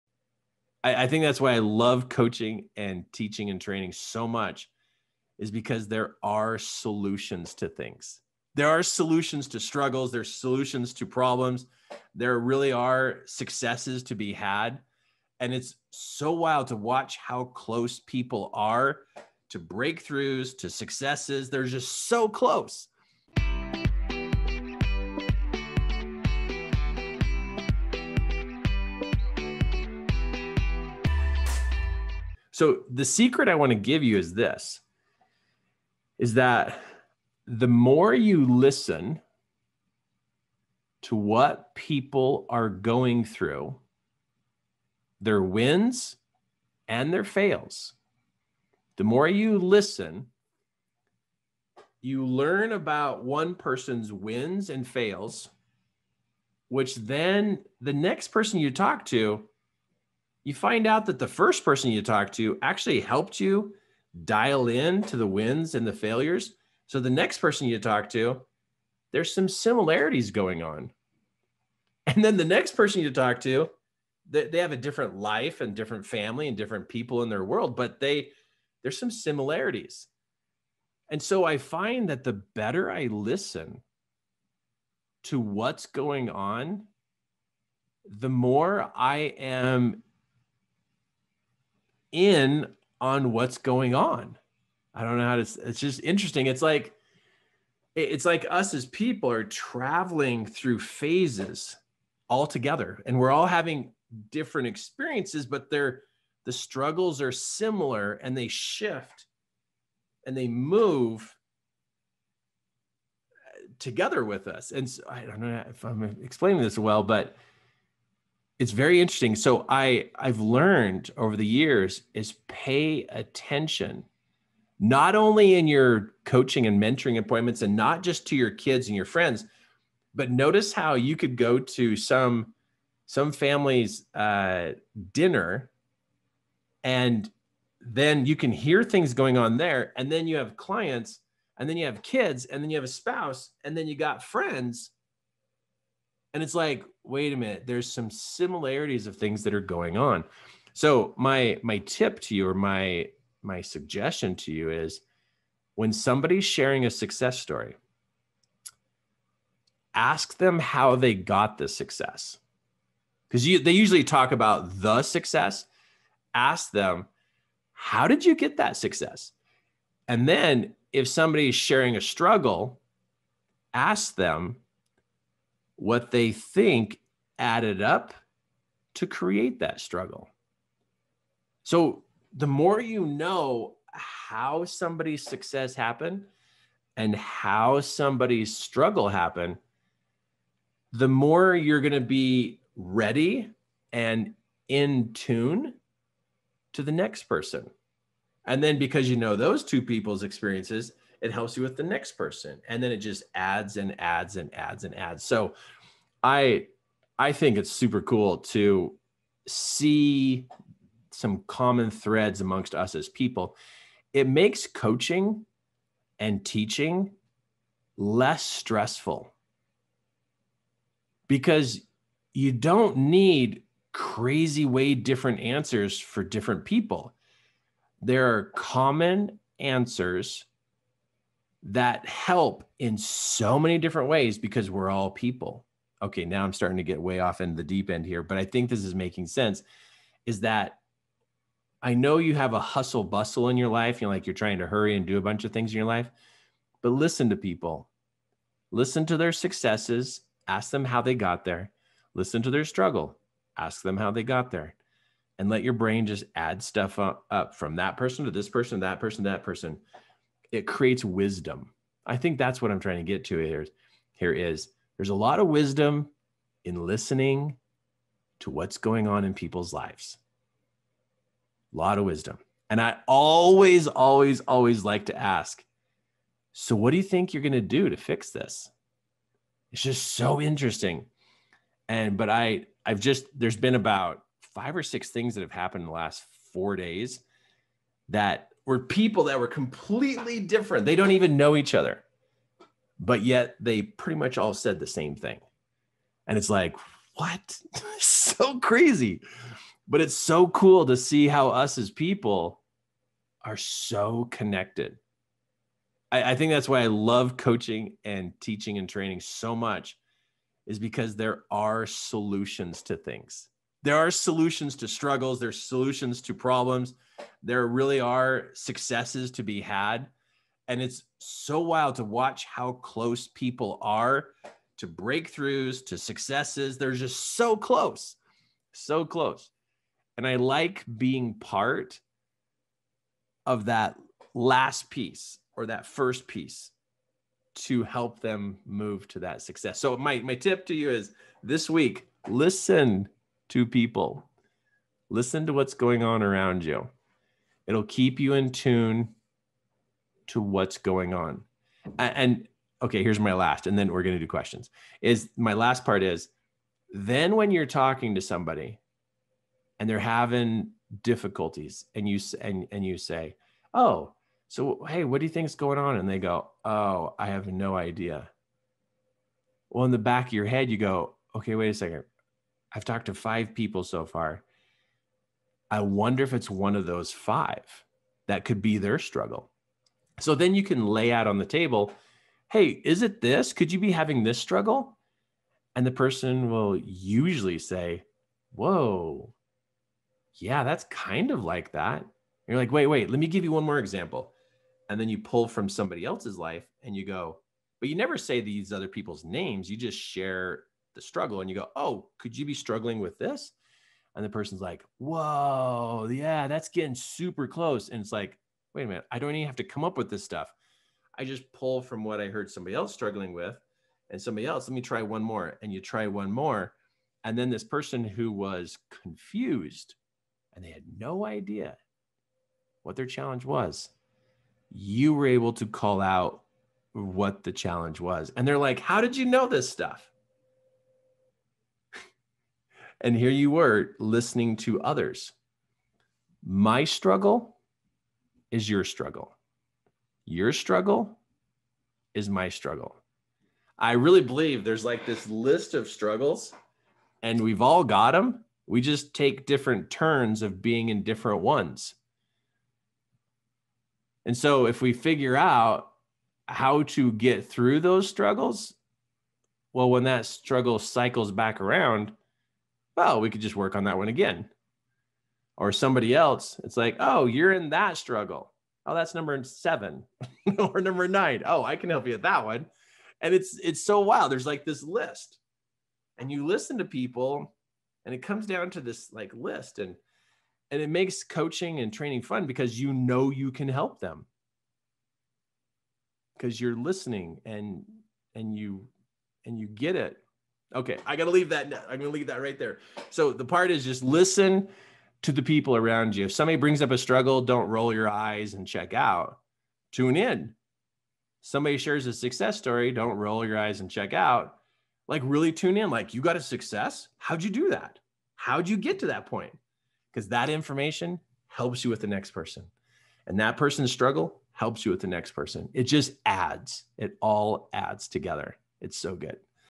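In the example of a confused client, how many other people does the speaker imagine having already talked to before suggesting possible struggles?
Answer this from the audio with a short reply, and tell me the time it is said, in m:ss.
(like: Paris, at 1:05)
5, at 6:13.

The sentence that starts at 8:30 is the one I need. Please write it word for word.
Because that information helps you with the next person.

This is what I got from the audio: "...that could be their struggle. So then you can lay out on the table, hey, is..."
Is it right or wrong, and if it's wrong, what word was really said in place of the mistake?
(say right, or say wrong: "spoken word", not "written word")
right.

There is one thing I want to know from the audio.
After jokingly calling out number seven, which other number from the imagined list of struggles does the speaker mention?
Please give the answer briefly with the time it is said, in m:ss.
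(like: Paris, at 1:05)
9, at 7:50.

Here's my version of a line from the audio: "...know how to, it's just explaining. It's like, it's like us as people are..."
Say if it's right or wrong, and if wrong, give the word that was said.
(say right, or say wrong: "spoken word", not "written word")
wrong: "interesting", not "explaining".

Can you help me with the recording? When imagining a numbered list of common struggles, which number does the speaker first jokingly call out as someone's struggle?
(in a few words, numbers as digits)
7.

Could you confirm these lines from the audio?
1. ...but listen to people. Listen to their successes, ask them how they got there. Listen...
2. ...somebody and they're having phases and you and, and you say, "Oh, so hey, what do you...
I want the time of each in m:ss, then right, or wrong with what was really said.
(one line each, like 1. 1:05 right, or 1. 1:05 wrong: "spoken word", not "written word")
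1. 4:06 right
2. 5:58 wrong: "difficulties", not "phases".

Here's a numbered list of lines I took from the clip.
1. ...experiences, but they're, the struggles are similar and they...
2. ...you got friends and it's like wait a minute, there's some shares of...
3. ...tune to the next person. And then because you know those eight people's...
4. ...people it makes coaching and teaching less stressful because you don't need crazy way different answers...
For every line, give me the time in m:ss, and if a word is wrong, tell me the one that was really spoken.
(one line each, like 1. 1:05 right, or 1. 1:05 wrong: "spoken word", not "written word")
1. 1:44 right
2. 2:23 wrong: "similarities", not "shares"
3. 3:15 wrong: "two", not "eight"
4. 3:33 right.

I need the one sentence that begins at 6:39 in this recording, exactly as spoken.
You just share the struggle and you go, oh, could you be struggling with this?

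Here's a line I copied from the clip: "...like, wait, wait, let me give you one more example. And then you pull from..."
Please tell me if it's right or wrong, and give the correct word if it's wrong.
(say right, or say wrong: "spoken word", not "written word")
right.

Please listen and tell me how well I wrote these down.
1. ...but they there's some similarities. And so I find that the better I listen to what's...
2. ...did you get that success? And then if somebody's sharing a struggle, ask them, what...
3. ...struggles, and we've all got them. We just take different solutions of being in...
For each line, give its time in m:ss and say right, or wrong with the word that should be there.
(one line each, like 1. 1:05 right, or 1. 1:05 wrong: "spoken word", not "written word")
1. 1:17 right
2. 2:48 right
3. 7:25 wrong: "turns", not "solutions".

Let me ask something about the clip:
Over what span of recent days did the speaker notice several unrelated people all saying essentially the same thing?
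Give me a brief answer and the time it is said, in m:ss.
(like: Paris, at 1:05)
4 days, at 4:45.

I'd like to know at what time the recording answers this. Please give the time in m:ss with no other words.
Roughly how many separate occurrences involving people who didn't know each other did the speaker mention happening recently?
4:43.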